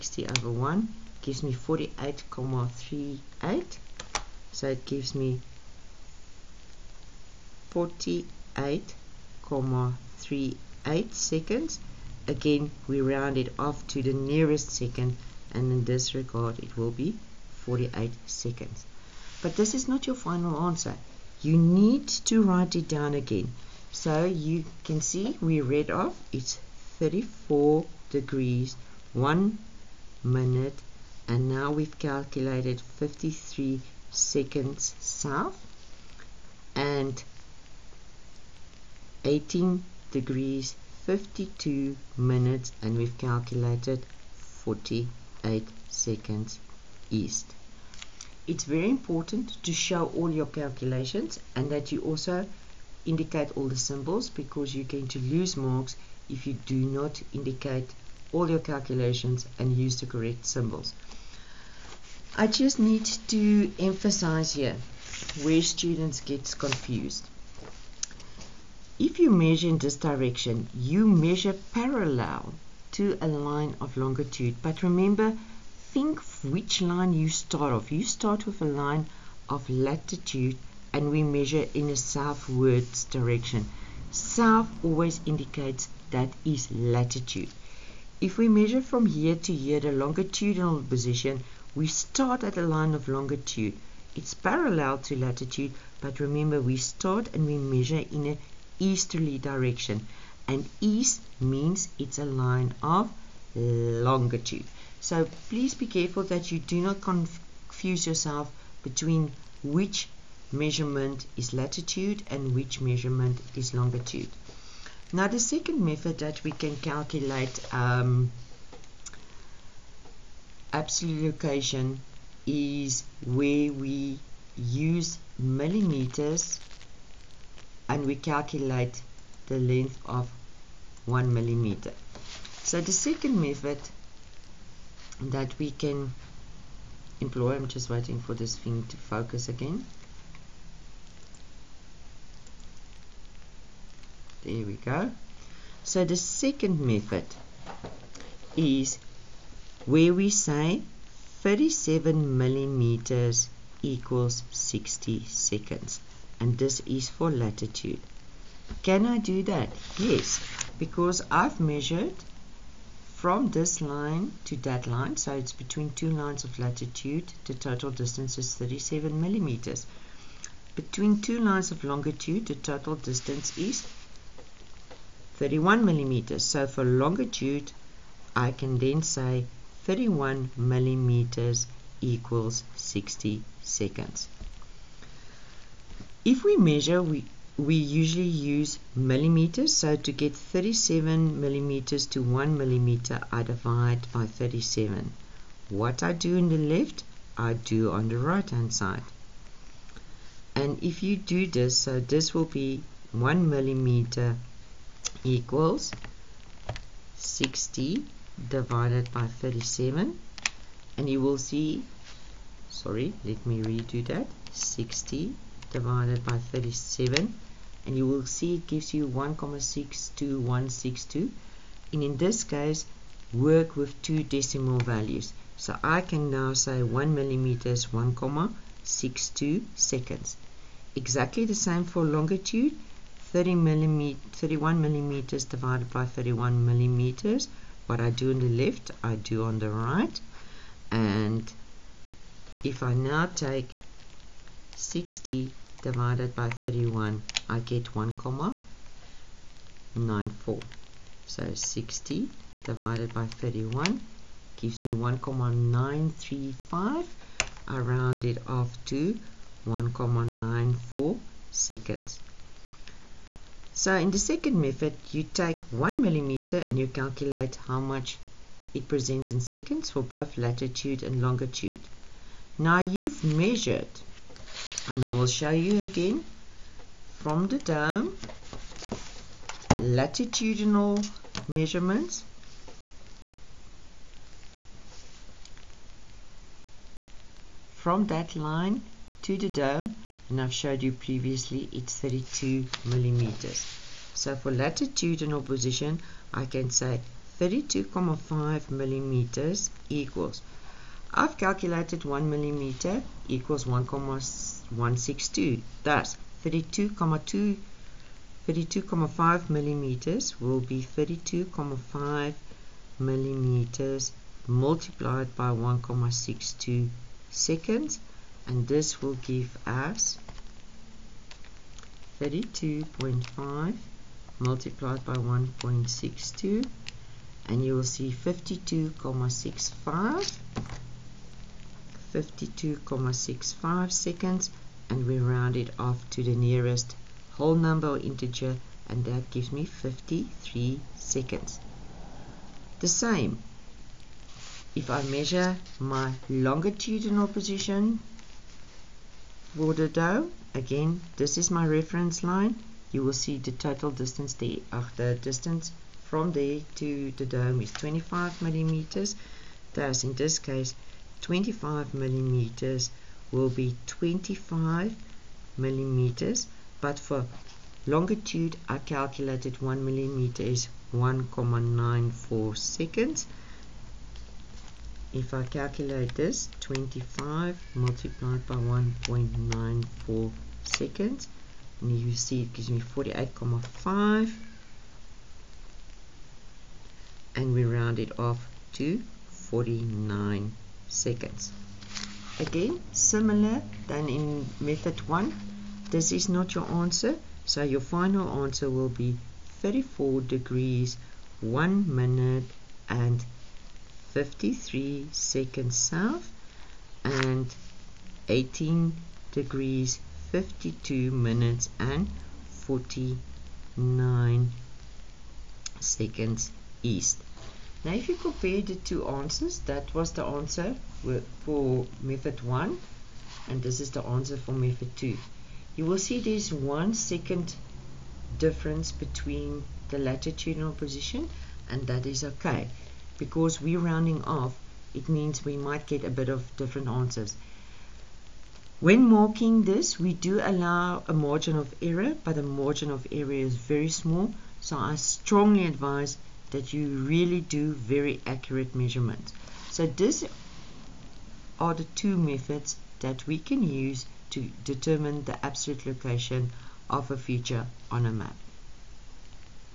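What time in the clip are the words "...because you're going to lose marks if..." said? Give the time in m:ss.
0:54.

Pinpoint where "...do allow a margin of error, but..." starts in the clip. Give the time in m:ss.
7:20.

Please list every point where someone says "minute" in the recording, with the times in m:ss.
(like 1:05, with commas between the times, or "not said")
0:30, 0:42, 6:41, 6:51.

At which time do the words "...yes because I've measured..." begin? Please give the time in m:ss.
2:39.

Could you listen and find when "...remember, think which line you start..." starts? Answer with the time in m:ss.
1:14.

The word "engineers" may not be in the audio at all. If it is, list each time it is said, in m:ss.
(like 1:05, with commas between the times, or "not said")
not said.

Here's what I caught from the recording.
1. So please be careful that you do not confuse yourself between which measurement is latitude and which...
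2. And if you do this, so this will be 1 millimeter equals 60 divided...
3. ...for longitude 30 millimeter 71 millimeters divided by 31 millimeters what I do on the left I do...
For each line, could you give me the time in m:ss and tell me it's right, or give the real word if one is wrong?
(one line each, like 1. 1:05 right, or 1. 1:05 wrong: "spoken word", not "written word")
1. 1:45 right
2. 3:20 right
3. 3:51 wrong: "31", not "71".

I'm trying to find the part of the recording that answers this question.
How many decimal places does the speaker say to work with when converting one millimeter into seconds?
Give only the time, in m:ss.
3:44.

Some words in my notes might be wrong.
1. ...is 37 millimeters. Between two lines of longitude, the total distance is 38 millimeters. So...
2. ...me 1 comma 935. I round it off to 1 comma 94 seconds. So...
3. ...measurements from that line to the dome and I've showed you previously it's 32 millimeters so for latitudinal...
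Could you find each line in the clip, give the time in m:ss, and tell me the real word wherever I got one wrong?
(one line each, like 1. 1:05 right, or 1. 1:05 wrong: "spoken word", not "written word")
1. 2:48 wrong: "31", not "38"
2. 4:14 right
3. 4:41 right.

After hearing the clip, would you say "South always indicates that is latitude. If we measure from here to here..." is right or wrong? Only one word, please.
right.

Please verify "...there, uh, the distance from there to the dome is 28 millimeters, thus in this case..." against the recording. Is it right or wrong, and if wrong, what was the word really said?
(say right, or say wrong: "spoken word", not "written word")
wrong: "25", not "28".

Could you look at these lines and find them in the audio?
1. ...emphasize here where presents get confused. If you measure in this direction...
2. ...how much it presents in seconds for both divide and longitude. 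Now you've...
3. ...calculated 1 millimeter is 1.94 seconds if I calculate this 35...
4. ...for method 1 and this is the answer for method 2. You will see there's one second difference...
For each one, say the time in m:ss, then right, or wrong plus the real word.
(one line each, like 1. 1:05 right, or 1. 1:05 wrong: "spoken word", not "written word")
1. 1:03 wrong: "students", not "presents"
2. 4:27 wrong: "latitude", not "divide"
3. 6:08 wrong: "25", not "35"
4. 7:01 right.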